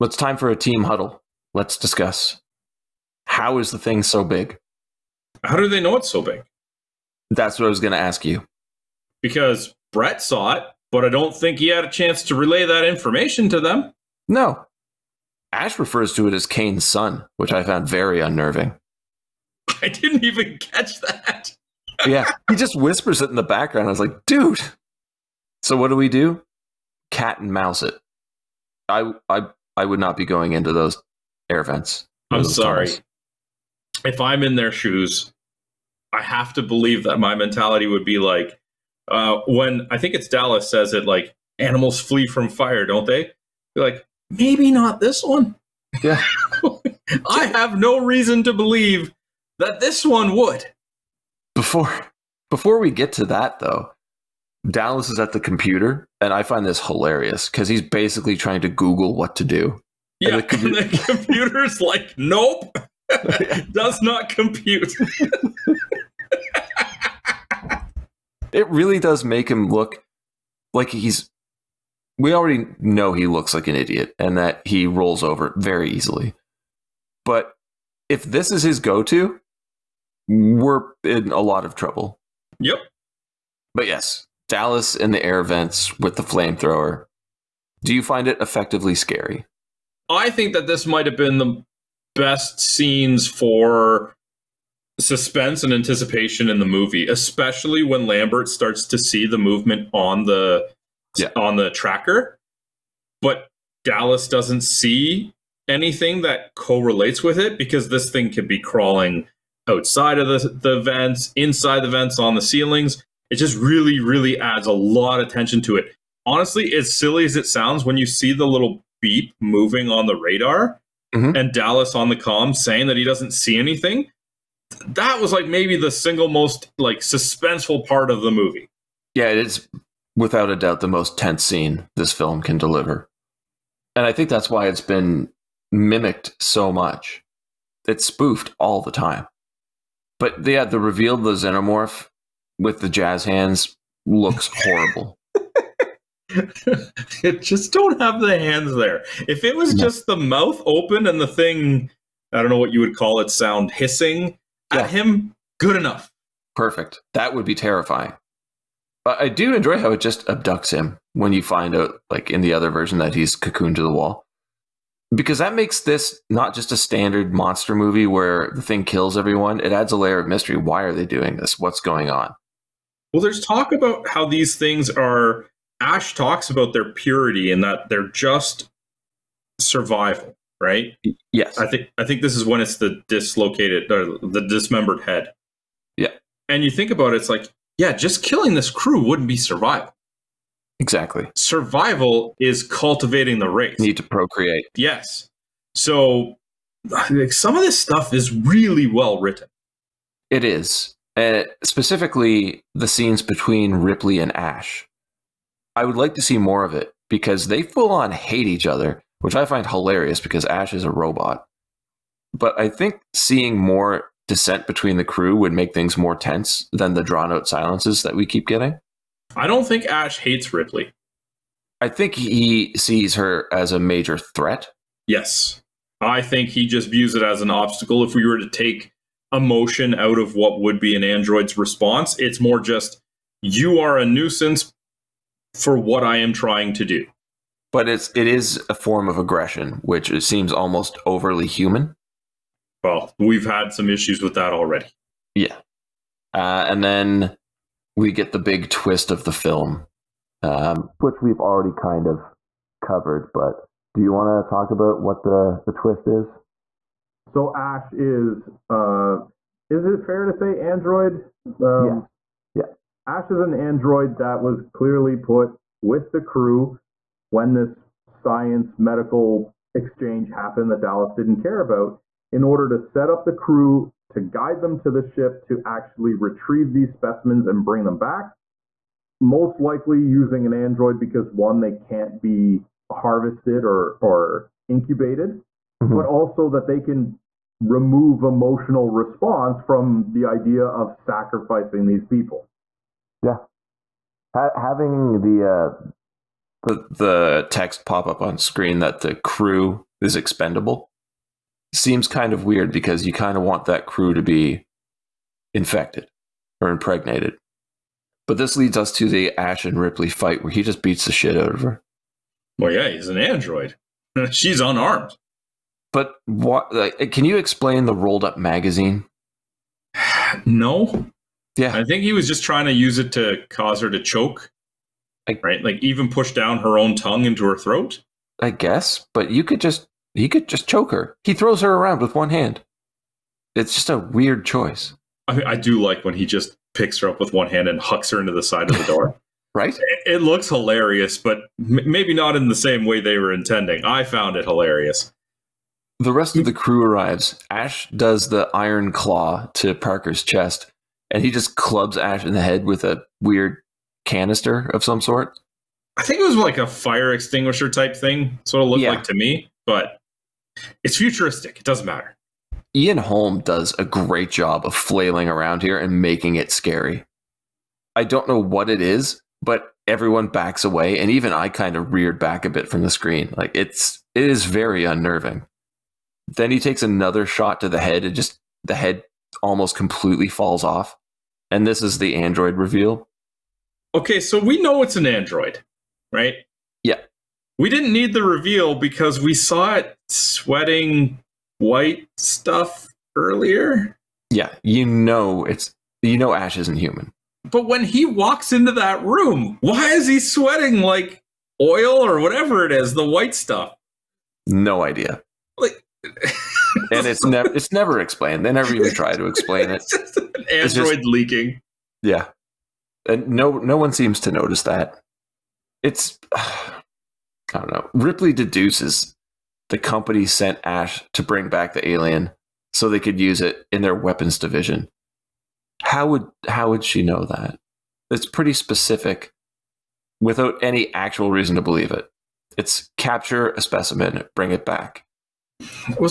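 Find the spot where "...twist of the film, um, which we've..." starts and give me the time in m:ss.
4:08.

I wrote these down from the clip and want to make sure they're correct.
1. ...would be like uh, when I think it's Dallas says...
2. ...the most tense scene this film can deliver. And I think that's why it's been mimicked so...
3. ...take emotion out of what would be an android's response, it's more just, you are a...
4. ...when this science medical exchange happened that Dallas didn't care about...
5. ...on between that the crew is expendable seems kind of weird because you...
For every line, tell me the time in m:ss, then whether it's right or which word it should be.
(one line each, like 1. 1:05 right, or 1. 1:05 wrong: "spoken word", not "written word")
1. 0:37 right
2. 2:10 right
3. 3:48 right
4. 4:27 right
5. 4:58 wrong: "screen", not "between".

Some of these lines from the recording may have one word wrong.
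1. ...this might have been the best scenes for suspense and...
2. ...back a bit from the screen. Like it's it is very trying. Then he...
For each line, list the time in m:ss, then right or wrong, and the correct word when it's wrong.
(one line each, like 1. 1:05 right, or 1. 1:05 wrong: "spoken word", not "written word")
1. 1:30 right
2. 6:12 wrong: "unnerving", not "trying".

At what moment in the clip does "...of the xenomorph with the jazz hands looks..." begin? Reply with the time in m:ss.
2:21.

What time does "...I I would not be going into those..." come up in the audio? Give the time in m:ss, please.
0:29.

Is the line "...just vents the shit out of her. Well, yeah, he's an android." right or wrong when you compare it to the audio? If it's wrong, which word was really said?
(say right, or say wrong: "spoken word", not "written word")
wrong: "beats", not "vents".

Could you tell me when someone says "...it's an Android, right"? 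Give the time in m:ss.
6:24.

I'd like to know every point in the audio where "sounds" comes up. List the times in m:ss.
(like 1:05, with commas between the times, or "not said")
1:57, 2:33.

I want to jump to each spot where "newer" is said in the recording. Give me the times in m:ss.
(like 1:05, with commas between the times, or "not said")
not said.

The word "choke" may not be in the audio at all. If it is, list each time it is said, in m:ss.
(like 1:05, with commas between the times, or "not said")
5:24, 5:30.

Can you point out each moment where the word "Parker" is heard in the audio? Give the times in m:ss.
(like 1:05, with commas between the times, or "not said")
5:49.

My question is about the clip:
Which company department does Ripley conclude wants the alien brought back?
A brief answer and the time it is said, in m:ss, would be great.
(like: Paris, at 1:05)
weapons division, at 7:03.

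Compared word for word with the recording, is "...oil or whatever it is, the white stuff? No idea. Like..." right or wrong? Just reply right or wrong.
right.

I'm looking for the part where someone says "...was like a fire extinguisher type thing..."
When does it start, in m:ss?
5:56.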